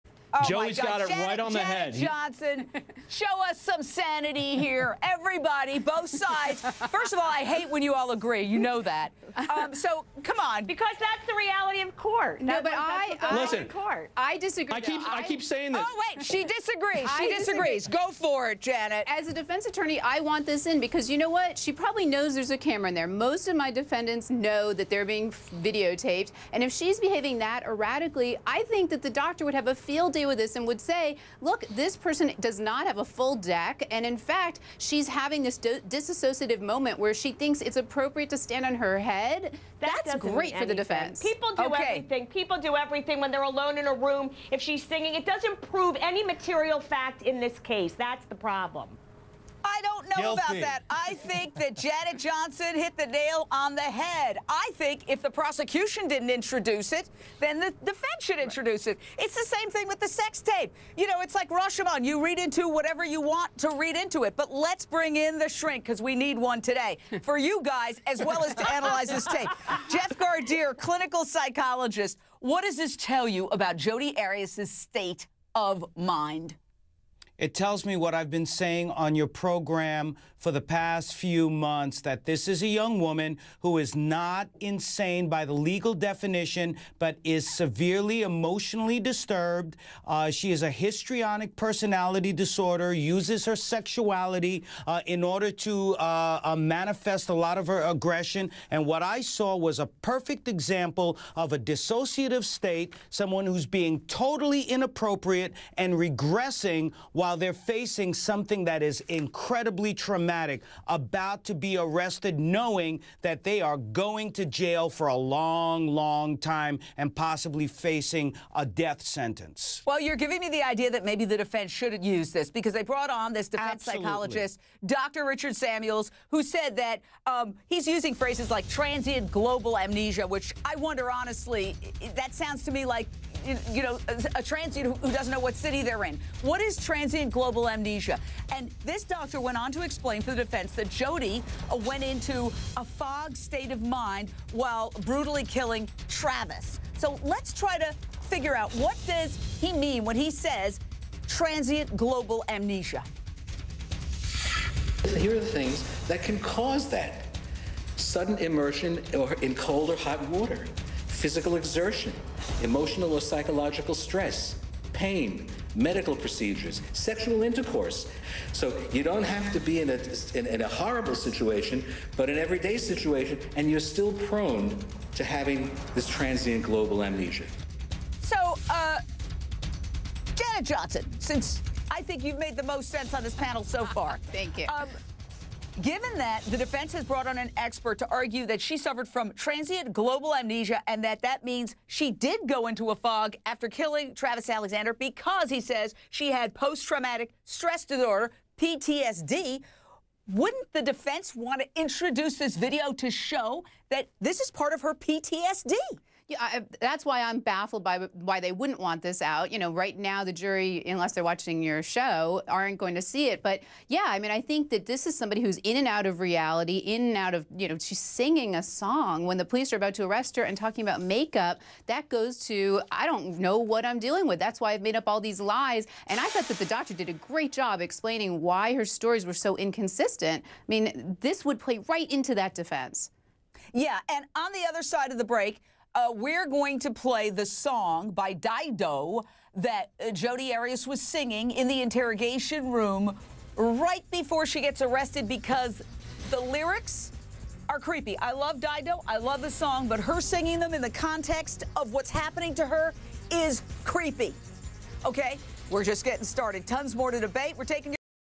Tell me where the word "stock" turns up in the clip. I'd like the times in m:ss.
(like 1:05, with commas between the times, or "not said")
not said.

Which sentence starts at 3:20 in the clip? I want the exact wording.
Wouldn't the defense want to introduce this video to show that this is part of her PTSD?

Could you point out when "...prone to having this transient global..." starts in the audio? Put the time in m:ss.
2:54.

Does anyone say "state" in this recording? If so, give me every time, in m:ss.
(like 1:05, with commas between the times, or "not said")
1:14, 1:42, 2:23.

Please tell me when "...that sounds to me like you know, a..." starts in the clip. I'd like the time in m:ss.
2:12.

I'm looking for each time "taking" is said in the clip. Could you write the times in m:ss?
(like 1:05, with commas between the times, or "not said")
4:17.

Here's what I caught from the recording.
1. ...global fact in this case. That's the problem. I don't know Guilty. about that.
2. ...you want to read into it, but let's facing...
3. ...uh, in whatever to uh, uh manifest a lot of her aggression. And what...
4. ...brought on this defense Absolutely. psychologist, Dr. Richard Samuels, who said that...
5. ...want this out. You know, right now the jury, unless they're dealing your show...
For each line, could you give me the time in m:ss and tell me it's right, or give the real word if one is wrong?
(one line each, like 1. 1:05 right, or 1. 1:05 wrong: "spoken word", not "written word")
1. 0:46 wrong: "material", not "global"
2. 1:03 wrong: "bring", not "facing"
3. 1:34 wrong: "order", not "whatever"
4. 2:02 right
5. 3:28 wrong: "watching", not "dealing".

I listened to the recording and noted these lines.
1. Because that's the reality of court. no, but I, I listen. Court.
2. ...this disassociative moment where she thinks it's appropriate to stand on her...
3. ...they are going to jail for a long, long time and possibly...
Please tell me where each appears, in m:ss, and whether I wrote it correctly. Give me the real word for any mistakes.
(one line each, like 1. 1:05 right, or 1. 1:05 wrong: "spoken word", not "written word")
1. 0:10 right
2. 0:35 right
3. 1:53 right.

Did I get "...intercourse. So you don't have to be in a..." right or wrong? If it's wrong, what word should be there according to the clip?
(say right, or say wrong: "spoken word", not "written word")
right.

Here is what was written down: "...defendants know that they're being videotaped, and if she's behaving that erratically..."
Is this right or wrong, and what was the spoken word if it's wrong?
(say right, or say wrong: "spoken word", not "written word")
right.